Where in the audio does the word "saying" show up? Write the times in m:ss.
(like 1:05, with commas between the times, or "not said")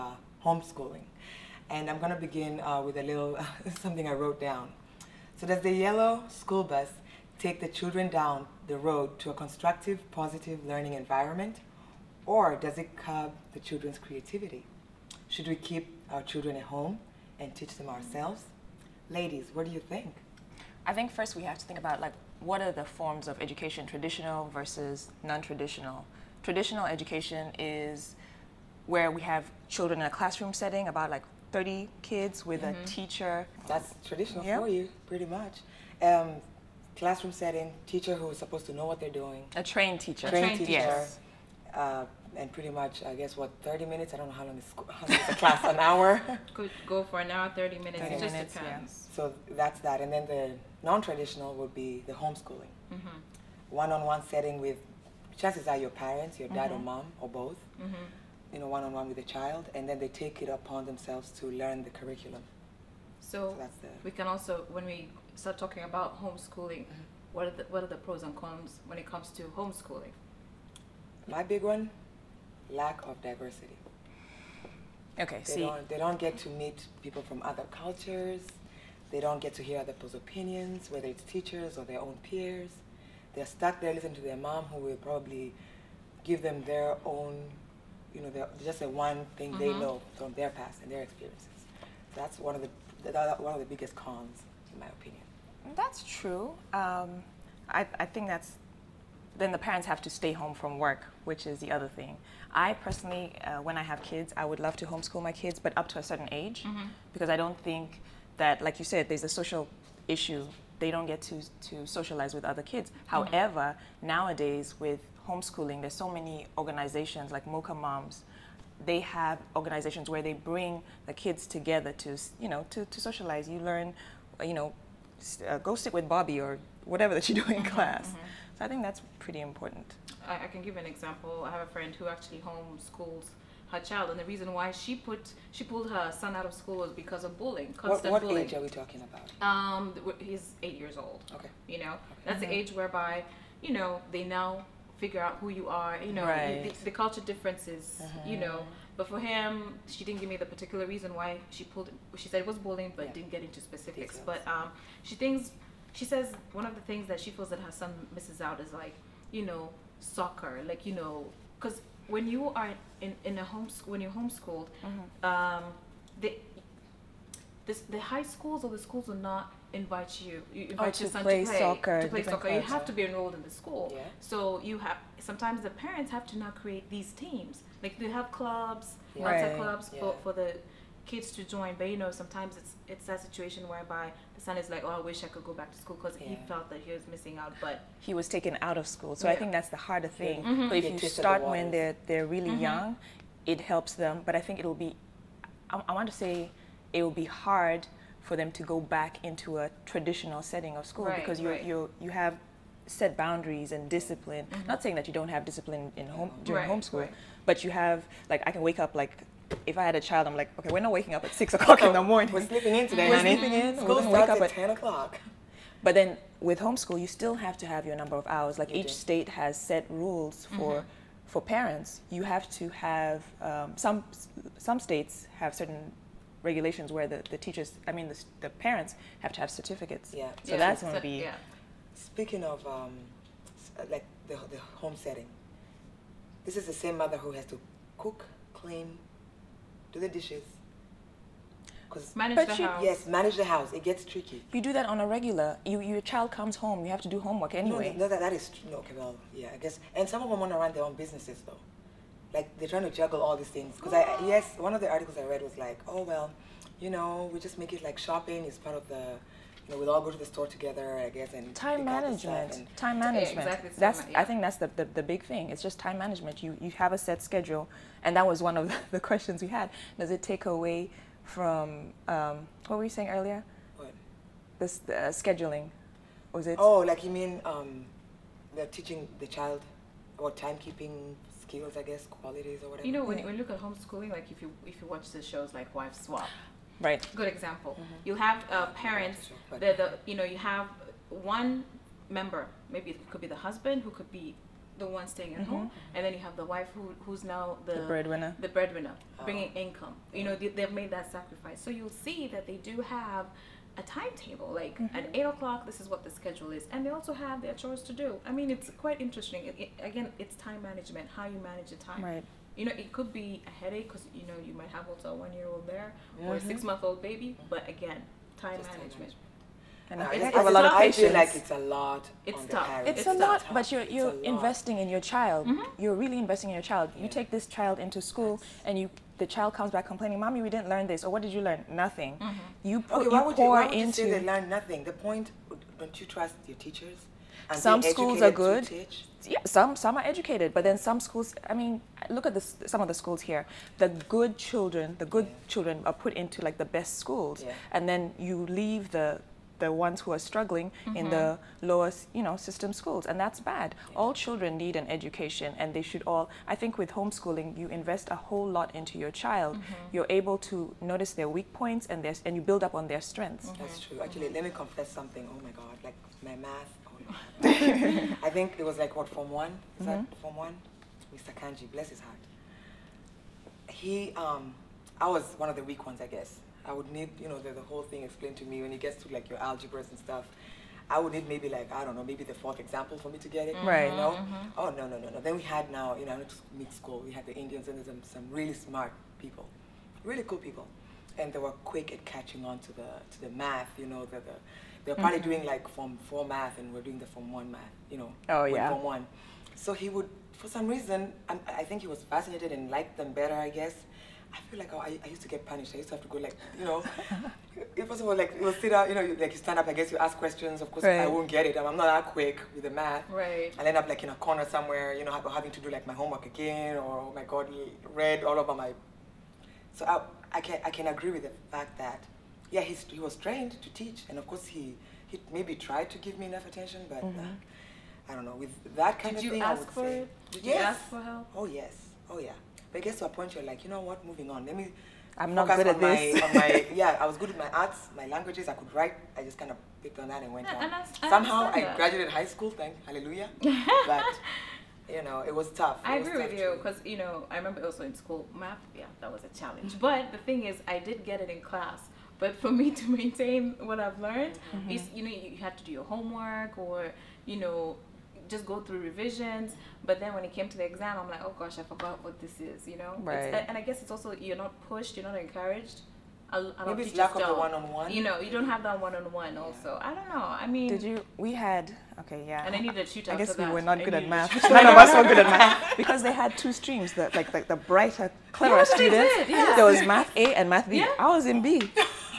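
3:24, 4:32.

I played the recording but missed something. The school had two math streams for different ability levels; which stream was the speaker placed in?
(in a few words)
Math B.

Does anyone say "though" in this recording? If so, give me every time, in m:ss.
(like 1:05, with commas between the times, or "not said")
4:11.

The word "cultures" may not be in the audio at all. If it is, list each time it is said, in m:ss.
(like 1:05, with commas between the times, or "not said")
1:17, 2:27.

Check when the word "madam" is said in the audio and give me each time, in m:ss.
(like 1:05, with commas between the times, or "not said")
not said.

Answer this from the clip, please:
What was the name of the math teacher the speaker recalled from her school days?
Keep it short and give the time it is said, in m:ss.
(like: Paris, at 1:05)
Mr. Kanji, at 6:11.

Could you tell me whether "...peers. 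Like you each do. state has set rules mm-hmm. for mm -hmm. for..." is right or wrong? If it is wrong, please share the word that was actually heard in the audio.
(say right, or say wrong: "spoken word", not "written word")
wrong: "hours", not "peers".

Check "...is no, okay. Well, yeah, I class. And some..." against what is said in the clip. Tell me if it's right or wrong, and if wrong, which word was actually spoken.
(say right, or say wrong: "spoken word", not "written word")
wrong: "guess", not "class".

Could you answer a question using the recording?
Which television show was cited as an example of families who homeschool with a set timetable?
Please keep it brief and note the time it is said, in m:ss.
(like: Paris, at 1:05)
Wife Swap, at 4:45.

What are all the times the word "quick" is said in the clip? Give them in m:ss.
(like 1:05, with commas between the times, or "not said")
6:31, 6:52.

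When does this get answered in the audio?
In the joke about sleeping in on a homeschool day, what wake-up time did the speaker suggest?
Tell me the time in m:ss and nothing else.
3:34.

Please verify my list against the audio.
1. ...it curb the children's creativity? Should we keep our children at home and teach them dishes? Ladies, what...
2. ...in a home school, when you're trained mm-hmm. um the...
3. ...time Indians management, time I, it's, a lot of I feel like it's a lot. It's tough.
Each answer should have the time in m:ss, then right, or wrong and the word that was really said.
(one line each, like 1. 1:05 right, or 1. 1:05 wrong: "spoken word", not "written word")
1. 0:12 wrong: "ourselves", not "dishes"
2. 2:43 wrong: "homeschooled", not "trained"
3. 5:18 wrong: "Just", not "Indians".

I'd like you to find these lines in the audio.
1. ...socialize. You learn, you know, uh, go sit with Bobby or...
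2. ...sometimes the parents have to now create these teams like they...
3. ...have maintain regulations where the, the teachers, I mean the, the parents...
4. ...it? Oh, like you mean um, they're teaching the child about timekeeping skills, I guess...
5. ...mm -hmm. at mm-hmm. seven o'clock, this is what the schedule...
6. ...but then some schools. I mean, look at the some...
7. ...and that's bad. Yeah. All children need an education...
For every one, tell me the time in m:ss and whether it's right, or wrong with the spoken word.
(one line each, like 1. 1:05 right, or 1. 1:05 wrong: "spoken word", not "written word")
1. 2:03 right
2. 2:55 right
3. 3:45 wrong: "certain", not "maintain"
4. 4:36 right
5. 5:04 wrong: "eight", not "seven"
6. 5:40 right
7. 5:53 right.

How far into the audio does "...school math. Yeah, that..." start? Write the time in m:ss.
7:28.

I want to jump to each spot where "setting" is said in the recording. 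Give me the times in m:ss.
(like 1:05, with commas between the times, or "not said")
0:30, 0:37, 0:54, 3:20, 3:54.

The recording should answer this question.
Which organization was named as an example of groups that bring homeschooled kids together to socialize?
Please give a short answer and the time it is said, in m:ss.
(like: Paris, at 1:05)
Mocha Moms, at 1:57.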